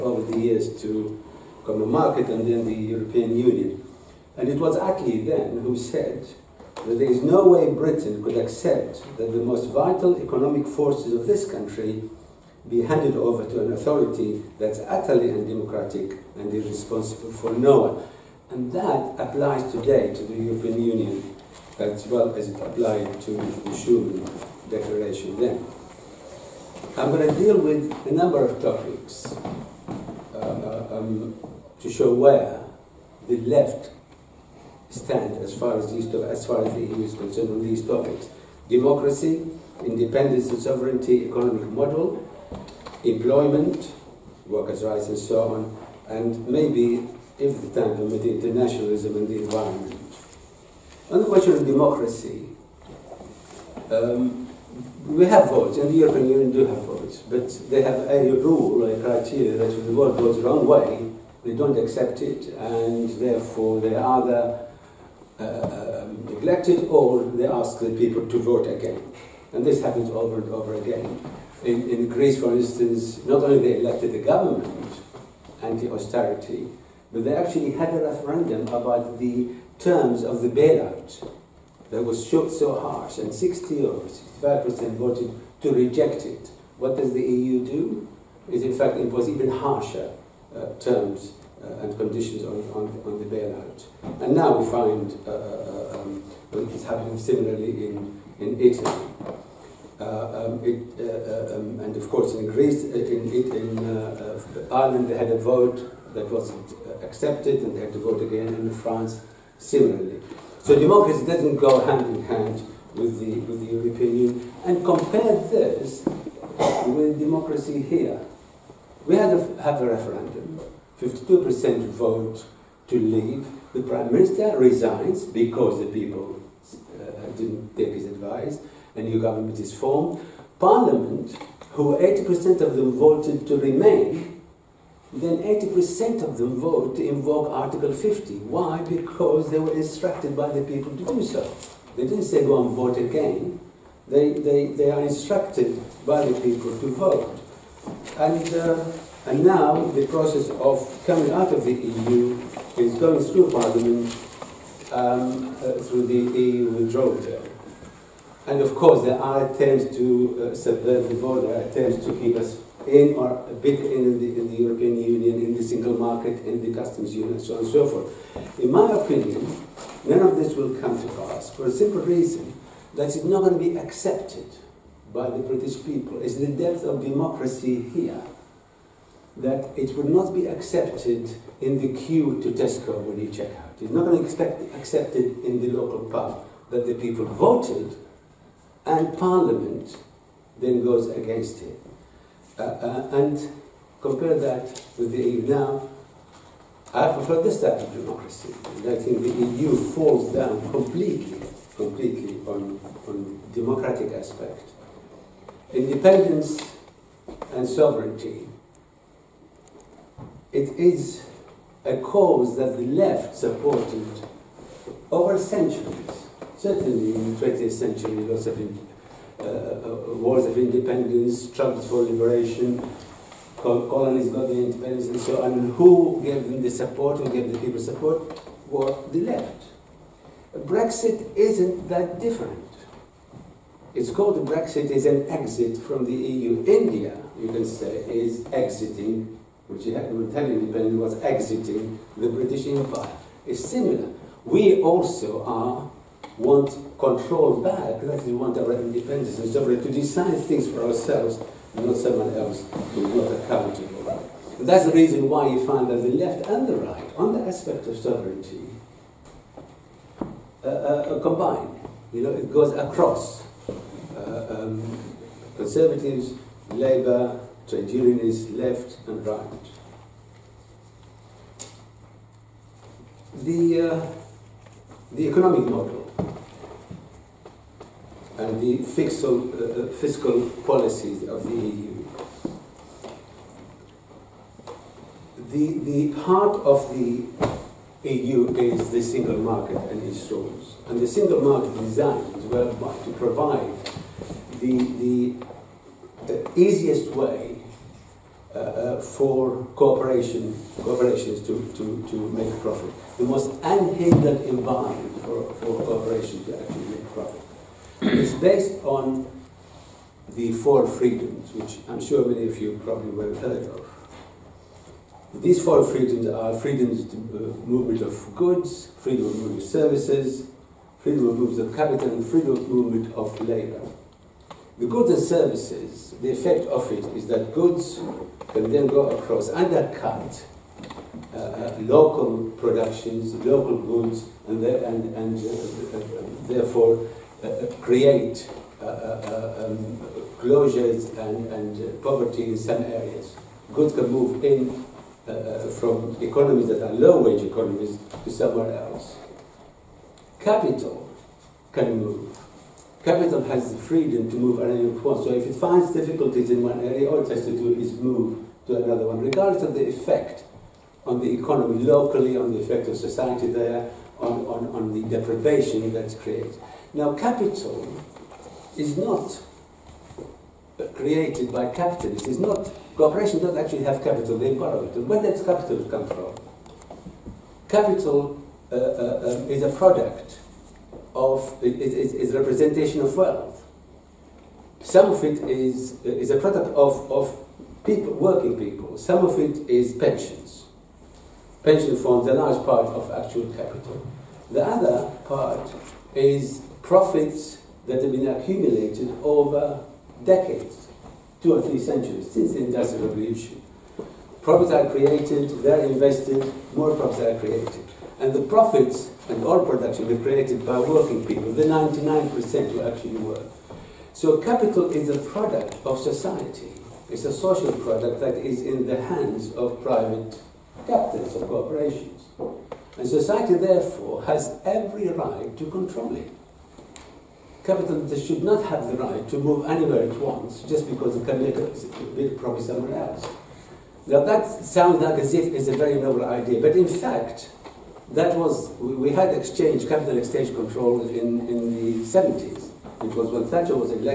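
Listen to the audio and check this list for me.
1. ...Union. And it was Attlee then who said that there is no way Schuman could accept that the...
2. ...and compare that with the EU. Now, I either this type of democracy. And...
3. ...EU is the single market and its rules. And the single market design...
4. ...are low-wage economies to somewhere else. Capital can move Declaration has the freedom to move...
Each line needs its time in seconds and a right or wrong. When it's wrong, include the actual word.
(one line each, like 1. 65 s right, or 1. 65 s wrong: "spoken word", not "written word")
1. 3 s wrong: "Britain", not "Schuman"
2. 193 s wrong: "prefer", not "either"
3. 288 s right
4. 346 s wrong: "Capital", not "Declaration".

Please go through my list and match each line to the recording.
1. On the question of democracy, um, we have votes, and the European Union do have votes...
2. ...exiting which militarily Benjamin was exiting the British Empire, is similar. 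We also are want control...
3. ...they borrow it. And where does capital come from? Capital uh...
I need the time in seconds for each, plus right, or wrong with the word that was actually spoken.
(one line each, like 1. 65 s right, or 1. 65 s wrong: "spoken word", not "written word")
1. 51 s right
2. 238 s right
3. 374 s right.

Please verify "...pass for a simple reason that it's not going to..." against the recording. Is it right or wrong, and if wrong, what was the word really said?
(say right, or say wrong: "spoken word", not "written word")
right.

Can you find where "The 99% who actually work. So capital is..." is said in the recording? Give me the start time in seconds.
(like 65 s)
411 s.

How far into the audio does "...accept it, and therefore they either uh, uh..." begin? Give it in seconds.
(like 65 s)
61 s.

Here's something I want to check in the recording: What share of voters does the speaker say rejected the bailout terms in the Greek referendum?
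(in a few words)
60 or 65%.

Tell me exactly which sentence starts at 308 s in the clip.
It's based on the four freedoms, which I'm sure many of you probably were heard of.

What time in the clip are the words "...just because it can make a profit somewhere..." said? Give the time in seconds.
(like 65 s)
430 s.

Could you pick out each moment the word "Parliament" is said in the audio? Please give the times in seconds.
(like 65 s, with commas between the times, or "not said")
130 s, 153 s, 189 s.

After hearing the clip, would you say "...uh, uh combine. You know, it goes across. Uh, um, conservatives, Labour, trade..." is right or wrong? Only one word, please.
right.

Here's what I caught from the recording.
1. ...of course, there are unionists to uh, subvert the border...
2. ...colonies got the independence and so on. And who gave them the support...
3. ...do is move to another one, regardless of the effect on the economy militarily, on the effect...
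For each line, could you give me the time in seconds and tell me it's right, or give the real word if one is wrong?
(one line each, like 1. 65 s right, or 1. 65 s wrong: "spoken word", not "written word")
1. 158 s wrong: "attempts", not "unionists"
2. 223 s right
3. 357 s wrong: "locally", not "militarily".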